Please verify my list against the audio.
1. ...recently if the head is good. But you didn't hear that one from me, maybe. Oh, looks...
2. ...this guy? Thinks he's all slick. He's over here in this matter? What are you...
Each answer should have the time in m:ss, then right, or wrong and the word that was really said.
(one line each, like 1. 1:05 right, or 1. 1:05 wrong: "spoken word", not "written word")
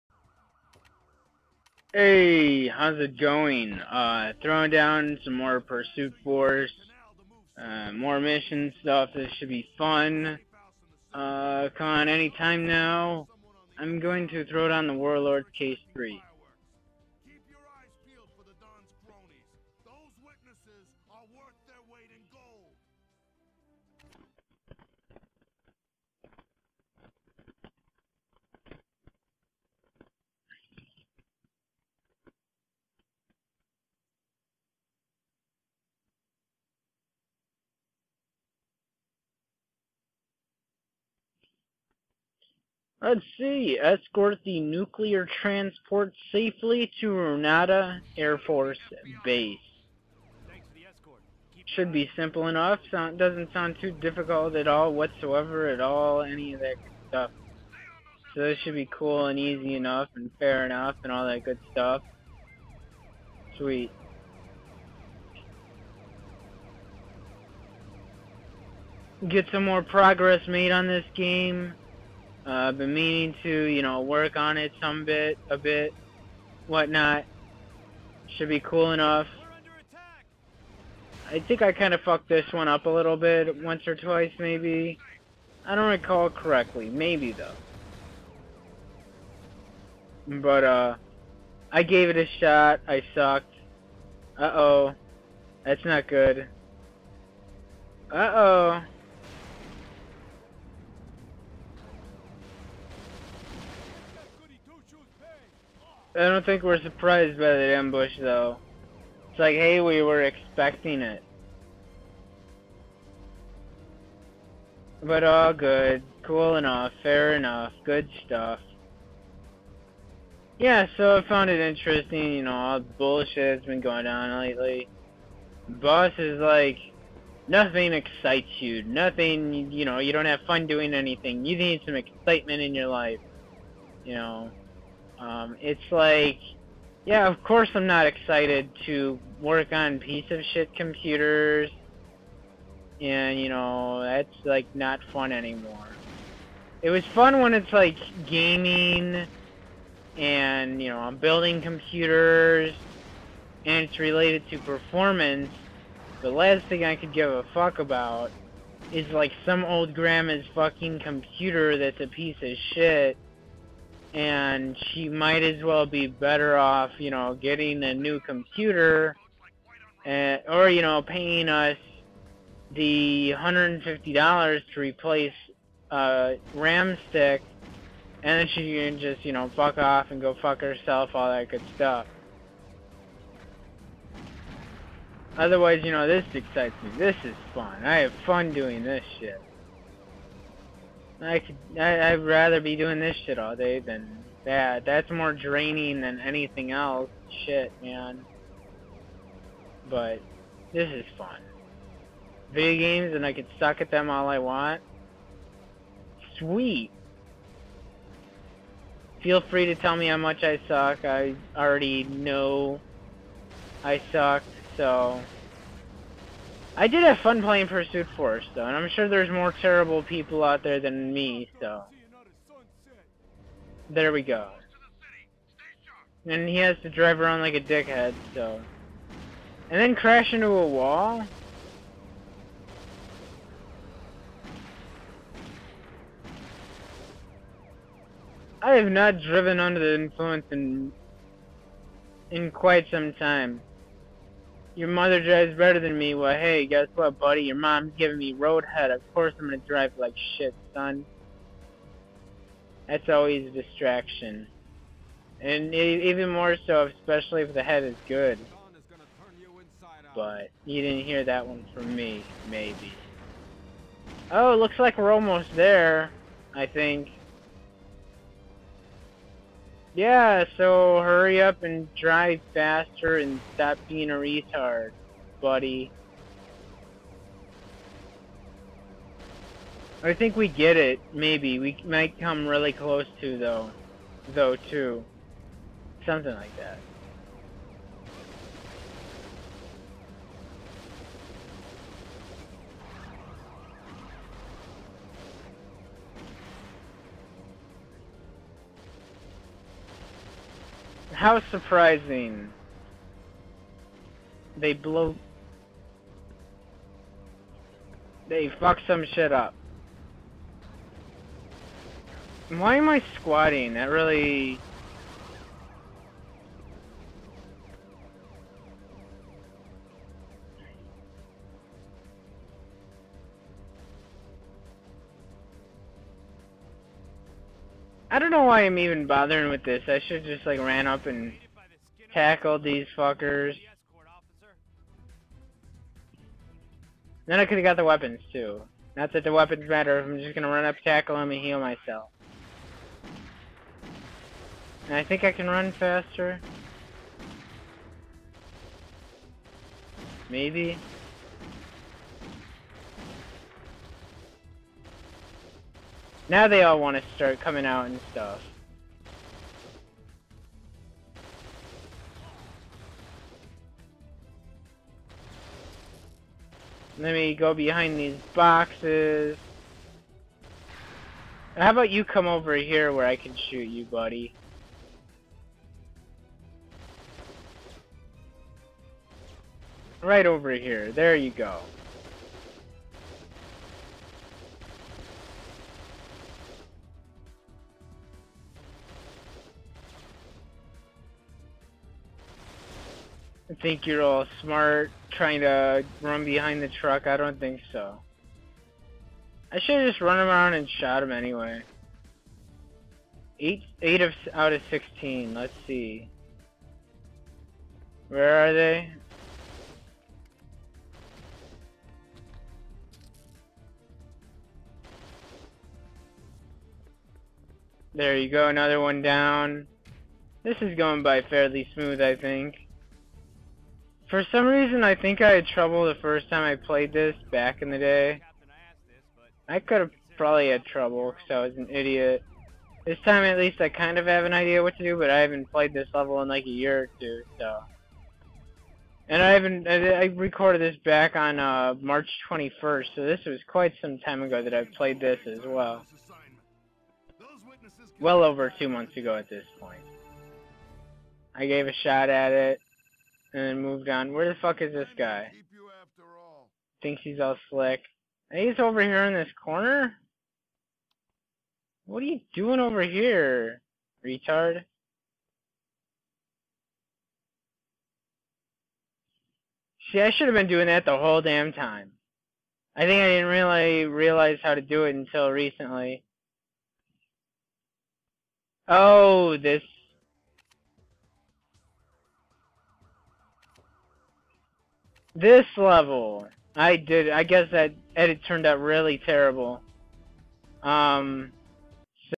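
1. 4:16 wrong: "especially", not "recently"
2. 7:34 wrong: "corner", not "matter".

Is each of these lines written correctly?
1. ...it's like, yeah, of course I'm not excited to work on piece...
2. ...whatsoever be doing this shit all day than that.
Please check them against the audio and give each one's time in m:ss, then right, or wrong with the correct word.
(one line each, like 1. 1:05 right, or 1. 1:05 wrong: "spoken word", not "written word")
1. 2:15 right
2. 3:12 wrong: "rather", not "whatsoever".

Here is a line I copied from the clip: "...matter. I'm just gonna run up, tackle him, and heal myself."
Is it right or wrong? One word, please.
right.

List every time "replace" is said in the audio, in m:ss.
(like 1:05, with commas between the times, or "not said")
2:54.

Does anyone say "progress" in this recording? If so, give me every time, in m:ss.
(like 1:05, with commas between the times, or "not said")
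1:09.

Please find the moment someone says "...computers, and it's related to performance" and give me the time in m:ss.
2:31.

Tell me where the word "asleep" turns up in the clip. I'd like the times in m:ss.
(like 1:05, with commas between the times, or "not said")
not said.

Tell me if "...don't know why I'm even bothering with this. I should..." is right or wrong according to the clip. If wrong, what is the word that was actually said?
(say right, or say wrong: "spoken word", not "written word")
right.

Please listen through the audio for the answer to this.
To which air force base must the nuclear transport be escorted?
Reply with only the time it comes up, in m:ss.
0:47.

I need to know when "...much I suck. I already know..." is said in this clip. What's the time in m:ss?
3:30.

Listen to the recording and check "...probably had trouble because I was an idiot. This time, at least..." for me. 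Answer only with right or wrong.
right.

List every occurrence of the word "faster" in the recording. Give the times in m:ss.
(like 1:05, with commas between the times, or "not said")
4:32, 5:45.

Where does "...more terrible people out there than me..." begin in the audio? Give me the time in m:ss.
3:39.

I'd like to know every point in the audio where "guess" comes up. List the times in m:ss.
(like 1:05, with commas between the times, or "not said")
4:06, 8:07.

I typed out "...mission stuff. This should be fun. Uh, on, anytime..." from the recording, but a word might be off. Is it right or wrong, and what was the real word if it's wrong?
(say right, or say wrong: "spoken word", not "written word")
right.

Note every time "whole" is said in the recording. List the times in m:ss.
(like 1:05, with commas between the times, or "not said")
7:50.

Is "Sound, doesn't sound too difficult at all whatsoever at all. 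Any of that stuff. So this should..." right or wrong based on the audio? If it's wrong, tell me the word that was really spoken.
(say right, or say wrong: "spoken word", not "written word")
right.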